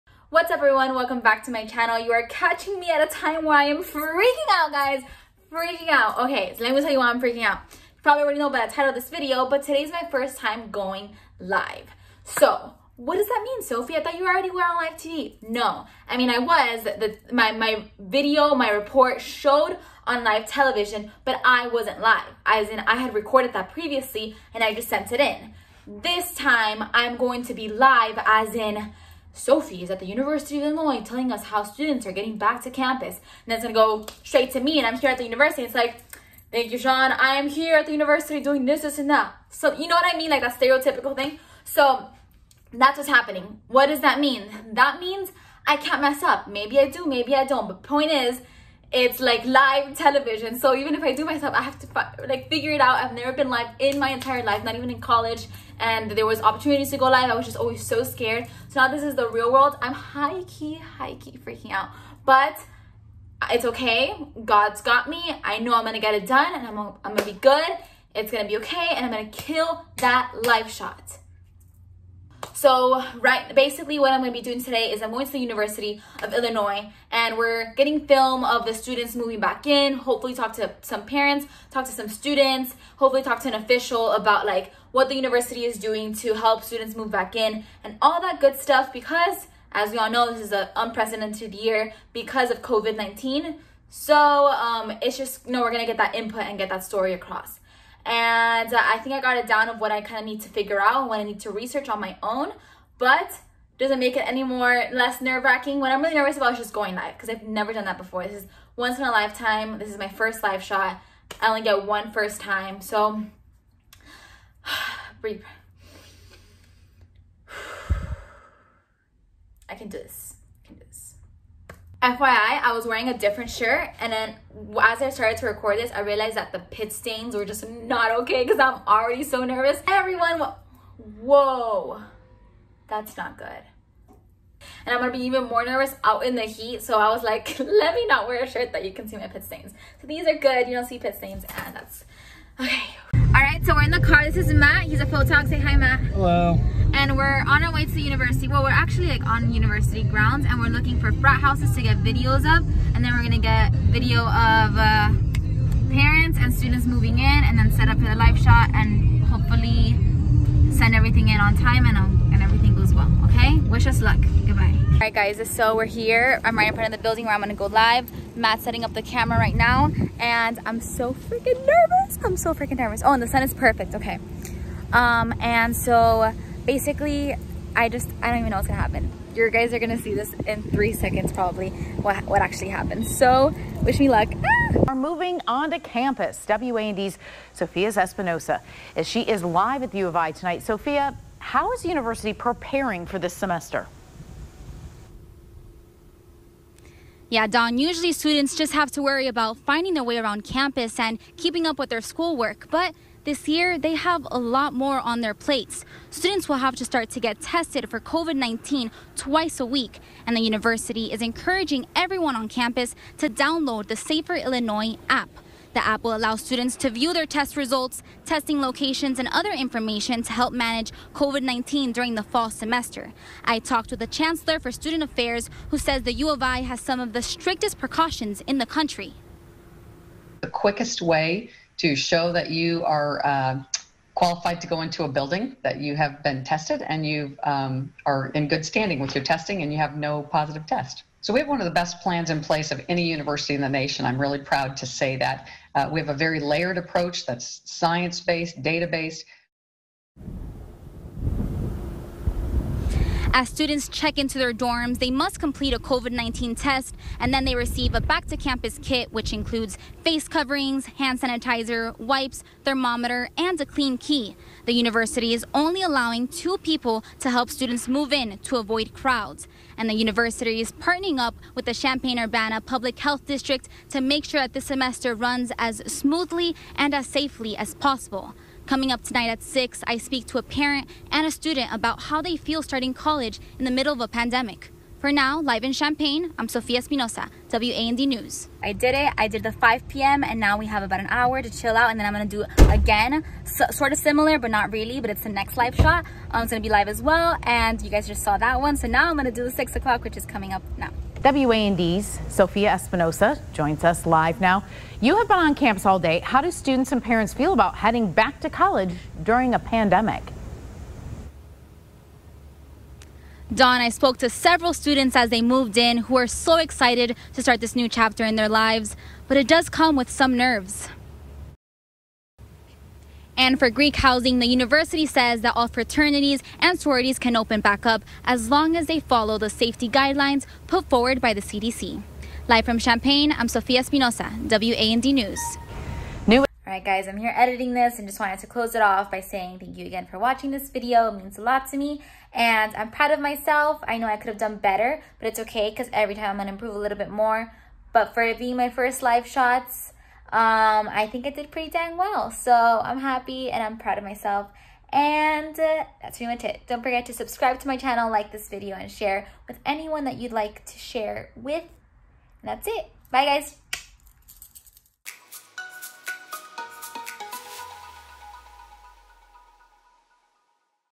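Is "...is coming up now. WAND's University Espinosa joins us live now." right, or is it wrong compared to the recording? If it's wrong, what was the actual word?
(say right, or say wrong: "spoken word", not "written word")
wrong: "Sophia", not "University".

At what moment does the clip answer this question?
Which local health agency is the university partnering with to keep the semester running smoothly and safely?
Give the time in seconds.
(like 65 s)
271 s.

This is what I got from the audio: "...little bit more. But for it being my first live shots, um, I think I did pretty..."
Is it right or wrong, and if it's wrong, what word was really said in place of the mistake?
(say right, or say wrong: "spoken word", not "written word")
right.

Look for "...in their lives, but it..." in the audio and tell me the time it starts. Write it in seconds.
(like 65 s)
318 s.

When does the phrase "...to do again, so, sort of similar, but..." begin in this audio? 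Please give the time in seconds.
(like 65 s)
292 s.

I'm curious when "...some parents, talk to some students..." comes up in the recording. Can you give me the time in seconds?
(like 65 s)
80 s.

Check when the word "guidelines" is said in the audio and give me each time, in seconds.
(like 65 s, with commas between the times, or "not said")
329 s.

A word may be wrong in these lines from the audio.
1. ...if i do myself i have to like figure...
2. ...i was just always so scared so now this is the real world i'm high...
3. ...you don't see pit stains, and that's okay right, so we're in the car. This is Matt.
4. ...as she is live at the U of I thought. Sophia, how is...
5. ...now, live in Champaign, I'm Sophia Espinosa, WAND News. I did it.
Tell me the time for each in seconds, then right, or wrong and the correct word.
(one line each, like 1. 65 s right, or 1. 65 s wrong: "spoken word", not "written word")
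1. 50 s right
2. 57 s right
3. 140 s right
4. 188 s wrong: "tonight", not "thought"
5. 285 s right.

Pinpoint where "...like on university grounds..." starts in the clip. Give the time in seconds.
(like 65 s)
149 s.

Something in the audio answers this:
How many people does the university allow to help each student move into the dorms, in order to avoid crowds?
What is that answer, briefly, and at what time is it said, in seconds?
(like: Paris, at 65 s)
2, at 266 s.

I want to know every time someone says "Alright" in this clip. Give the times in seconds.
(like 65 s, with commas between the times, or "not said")
336 s.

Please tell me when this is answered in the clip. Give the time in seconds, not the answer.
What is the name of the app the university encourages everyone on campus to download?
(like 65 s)
213 s.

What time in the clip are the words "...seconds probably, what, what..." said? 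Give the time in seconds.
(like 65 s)
180 s.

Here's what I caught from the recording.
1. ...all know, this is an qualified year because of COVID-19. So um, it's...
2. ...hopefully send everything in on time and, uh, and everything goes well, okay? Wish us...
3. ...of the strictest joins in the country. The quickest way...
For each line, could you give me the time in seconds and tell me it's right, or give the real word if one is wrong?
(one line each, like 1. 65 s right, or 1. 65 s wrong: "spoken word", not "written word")
1. 89 s wrong: "unprecedented", not "qualified"
2. 159 s right
3. 226 s wrong: "precautions", not "joins".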